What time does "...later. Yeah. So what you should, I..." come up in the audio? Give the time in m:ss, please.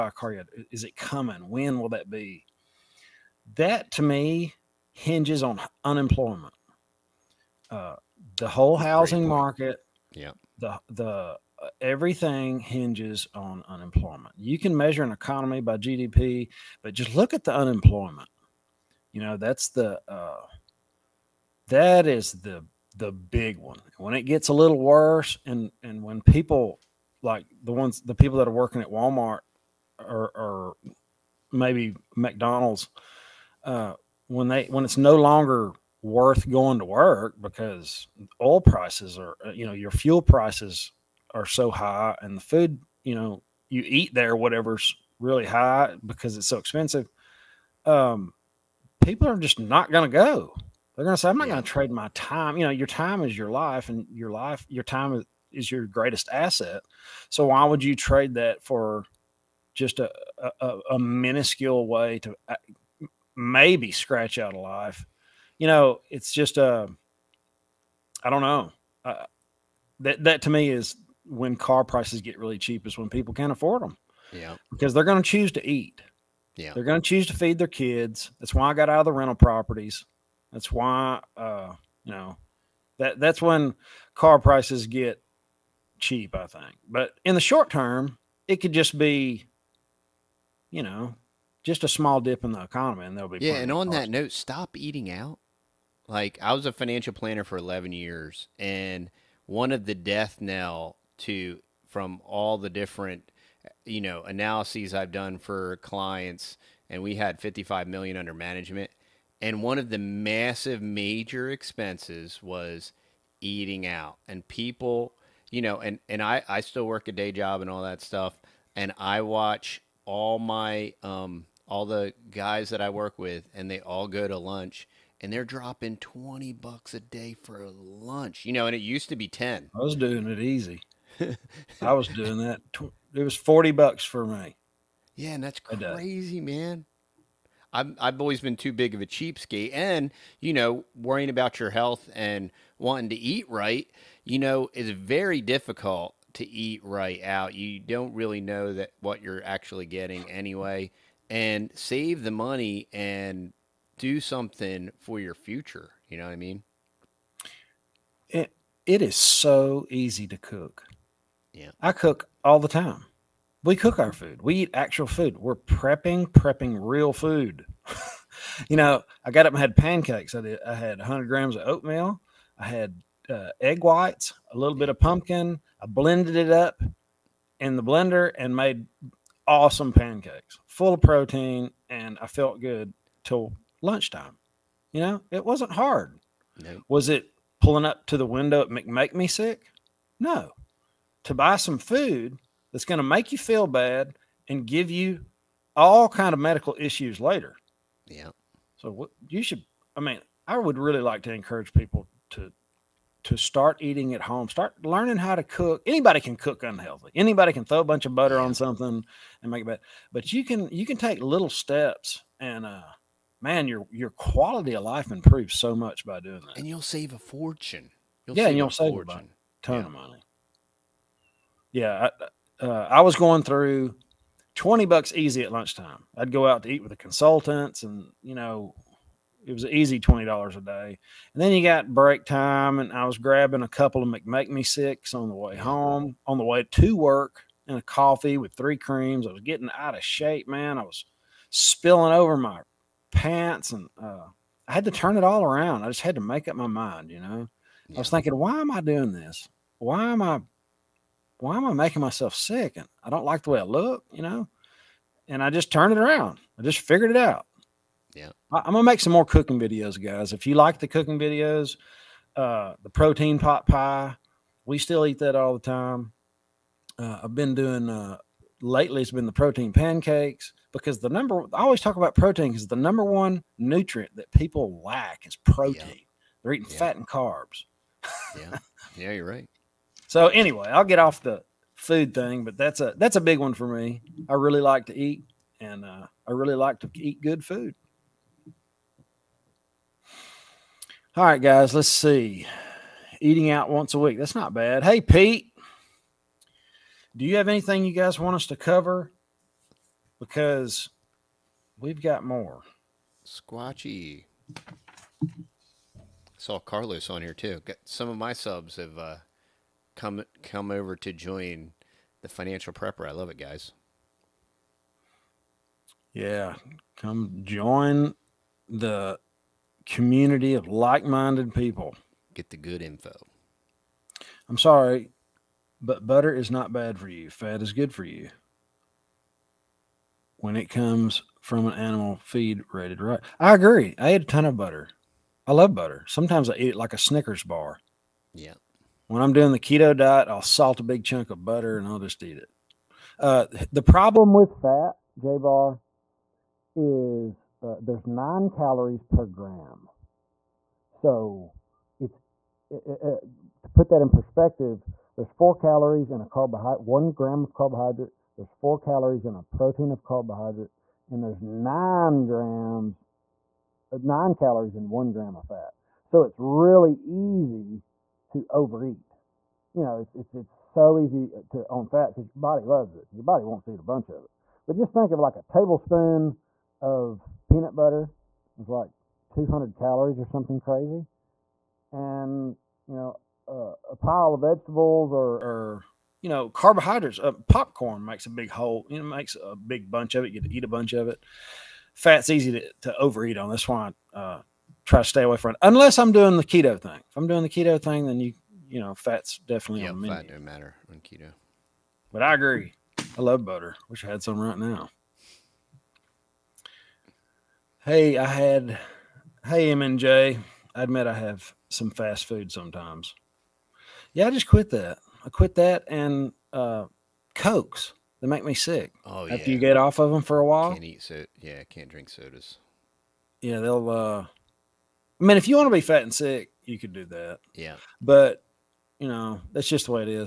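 3:17.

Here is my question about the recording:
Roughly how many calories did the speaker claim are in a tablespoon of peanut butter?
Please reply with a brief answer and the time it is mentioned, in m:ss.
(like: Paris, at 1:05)
200, at 6:19.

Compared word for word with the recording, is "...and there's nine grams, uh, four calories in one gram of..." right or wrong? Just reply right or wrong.
wrong.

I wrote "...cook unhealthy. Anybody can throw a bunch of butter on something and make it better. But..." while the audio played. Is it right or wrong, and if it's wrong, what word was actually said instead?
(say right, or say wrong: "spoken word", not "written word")
right.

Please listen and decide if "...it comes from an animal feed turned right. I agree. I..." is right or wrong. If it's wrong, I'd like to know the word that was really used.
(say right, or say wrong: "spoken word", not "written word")
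wrong: "rated", not "turned".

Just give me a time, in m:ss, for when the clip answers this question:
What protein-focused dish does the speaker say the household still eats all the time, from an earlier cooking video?
4:22.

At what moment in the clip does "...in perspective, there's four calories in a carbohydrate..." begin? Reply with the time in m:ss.
5:54.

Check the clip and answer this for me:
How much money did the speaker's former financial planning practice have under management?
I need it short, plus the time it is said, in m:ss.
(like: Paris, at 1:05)
55 million, at 1:47.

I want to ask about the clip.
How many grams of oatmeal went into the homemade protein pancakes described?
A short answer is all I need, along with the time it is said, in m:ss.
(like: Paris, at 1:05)
100, at 2:50.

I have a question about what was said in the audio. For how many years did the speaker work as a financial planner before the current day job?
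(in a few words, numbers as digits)
11.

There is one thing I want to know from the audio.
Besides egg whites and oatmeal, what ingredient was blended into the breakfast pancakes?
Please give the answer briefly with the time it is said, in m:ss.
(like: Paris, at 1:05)
pumpkin, at 2:55.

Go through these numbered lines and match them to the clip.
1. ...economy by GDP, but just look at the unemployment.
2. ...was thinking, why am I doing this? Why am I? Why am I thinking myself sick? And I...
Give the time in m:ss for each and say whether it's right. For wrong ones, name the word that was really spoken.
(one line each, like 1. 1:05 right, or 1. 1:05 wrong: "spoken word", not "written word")
1. 0:15 right
2. 4:07 wrong: "making", not "thinking".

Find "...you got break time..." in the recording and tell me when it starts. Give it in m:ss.
3:51.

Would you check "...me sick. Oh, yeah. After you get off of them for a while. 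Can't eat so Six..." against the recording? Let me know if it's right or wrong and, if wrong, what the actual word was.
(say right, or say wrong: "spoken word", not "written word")
wrong: "Yeah", not "Six".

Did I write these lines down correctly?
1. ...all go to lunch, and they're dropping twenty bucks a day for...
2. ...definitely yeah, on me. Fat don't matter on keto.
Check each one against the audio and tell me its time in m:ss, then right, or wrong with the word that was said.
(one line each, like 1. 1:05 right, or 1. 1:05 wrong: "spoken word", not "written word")
1. 2:03 right
2. 6:39 right.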